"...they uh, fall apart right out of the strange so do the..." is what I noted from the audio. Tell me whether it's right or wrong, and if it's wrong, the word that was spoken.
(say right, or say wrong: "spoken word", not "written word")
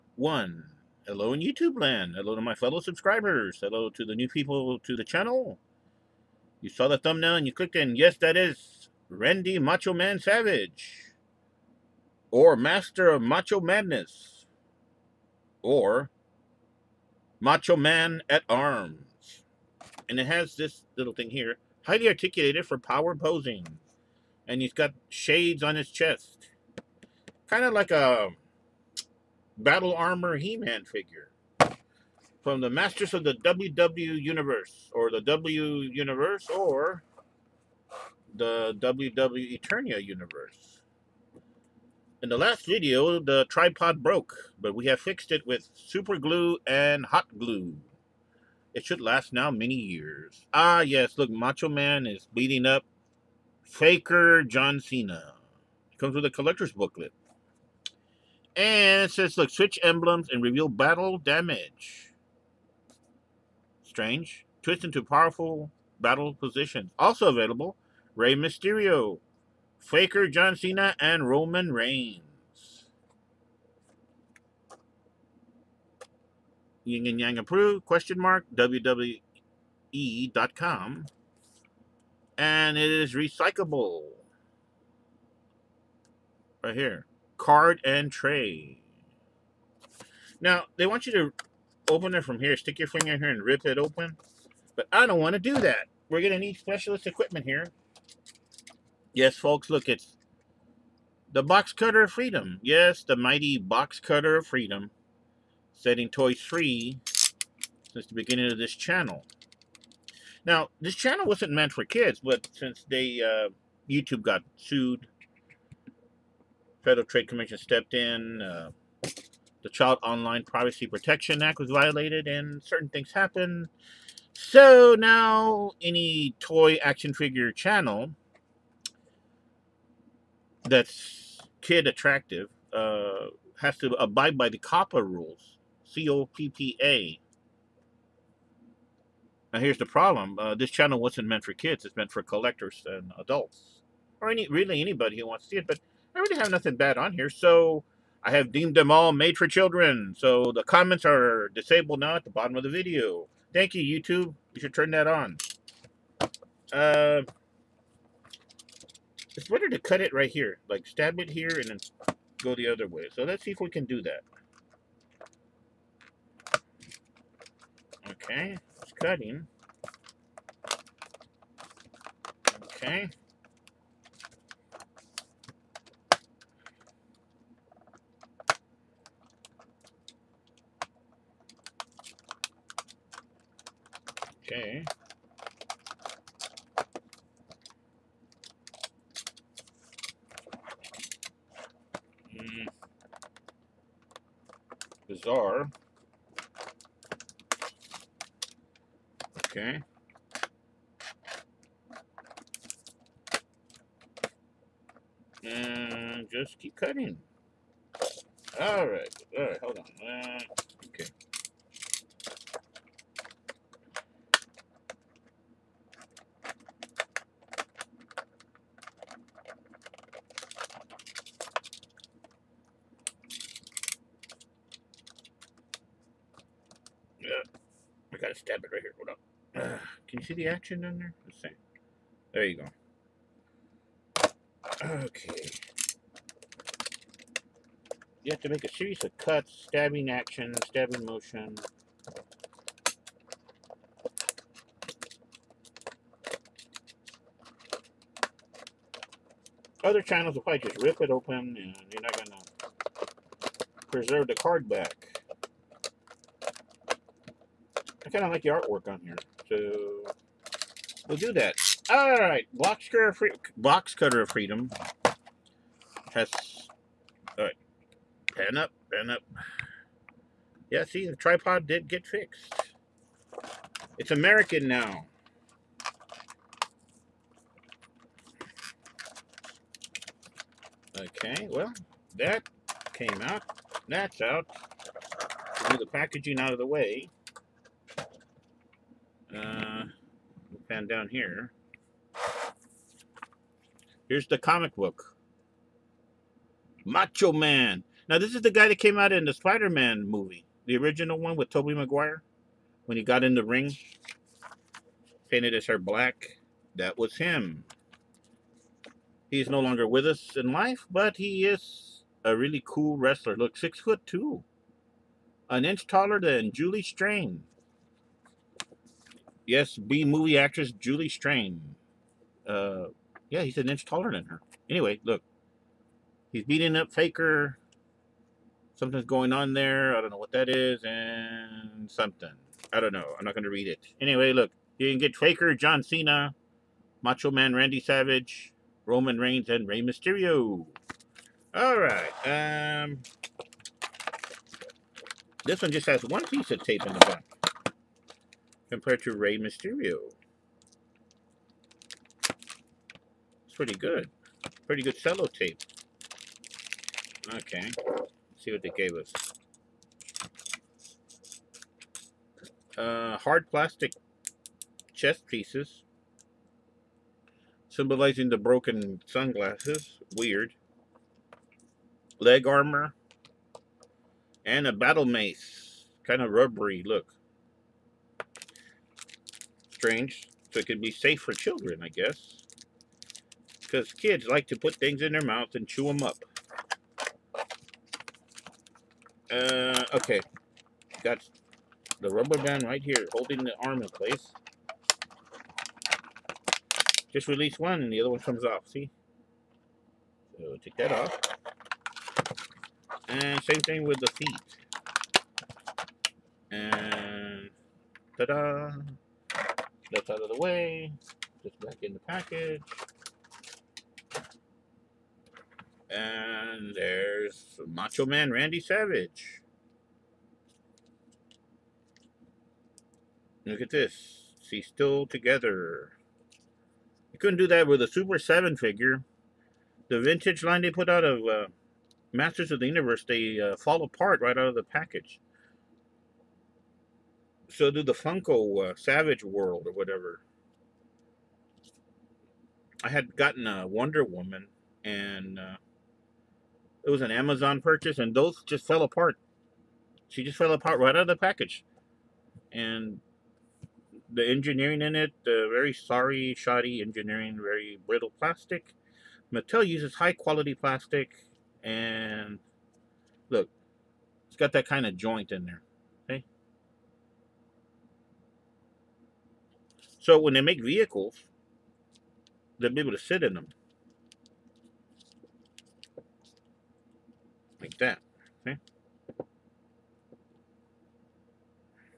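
wrong: "package", not "strange".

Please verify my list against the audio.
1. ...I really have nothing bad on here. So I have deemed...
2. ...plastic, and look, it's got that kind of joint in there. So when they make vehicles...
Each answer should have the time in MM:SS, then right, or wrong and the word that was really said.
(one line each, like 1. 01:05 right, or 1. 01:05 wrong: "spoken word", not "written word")
1. 02:26 right
2. 07:40 right.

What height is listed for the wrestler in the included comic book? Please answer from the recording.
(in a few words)
6 foot 2.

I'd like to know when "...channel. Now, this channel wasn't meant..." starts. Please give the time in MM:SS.
01:48.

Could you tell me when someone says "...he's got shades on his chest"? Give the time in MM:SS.
00:24.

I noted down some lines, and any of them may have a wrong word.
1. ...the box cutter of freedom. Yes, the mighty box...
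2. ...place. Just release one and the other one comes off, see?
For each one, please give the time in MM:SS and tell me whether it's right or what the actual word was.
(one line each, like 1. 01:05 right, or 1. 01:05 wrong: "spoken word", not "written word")
1. 01:41 right
2. 06:33 right.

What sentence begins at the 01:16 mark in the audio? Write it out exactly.
Yin and Yang approved, question mark, WWE.com.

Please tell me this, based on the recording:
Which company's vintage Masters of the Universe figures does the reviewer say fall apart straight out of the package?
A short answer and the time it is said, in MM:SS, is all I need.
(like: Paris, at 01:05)
Super 7, at 07:07.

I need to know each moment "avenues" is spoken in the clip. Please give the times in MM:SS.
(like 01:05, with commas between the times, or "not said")
not said.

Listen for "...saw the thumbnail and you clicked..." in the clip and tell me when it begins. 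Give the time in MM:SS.
00:06.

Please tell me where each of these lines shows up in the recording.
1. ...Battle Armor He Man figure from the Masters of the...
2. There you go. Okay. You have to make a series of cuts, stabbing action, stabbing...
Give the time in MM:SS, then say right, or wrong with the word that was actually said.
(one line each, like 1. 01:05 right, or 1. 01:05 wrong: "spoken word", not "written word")
1. 00:29 right
2. 03:52 right.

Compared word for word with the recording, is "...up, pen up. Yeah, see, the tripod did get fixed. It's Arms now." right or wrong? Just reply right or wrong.
wrong.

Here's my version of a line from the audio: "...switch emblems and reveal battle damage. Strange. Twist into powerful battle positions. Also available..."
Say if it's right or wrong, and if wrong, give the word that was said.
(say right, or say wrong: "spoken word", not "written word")
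right.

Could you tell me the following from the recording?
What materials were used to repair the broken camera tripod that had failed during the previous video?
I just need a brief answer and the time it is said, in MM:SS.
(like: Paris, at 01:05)
Super glue and hot glue, at 00:45.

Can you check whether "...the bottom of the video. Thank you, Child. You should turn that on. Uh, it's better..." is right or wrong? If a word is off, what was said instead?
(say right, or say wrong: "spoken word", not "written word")
wrong: "YouTube", not "Child".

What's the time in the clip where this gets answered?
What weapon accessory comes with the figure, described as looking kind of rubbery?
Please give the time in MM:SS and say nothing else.
06:14.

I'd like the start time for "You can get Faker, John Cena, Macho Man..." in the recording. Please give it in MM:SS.
05:34.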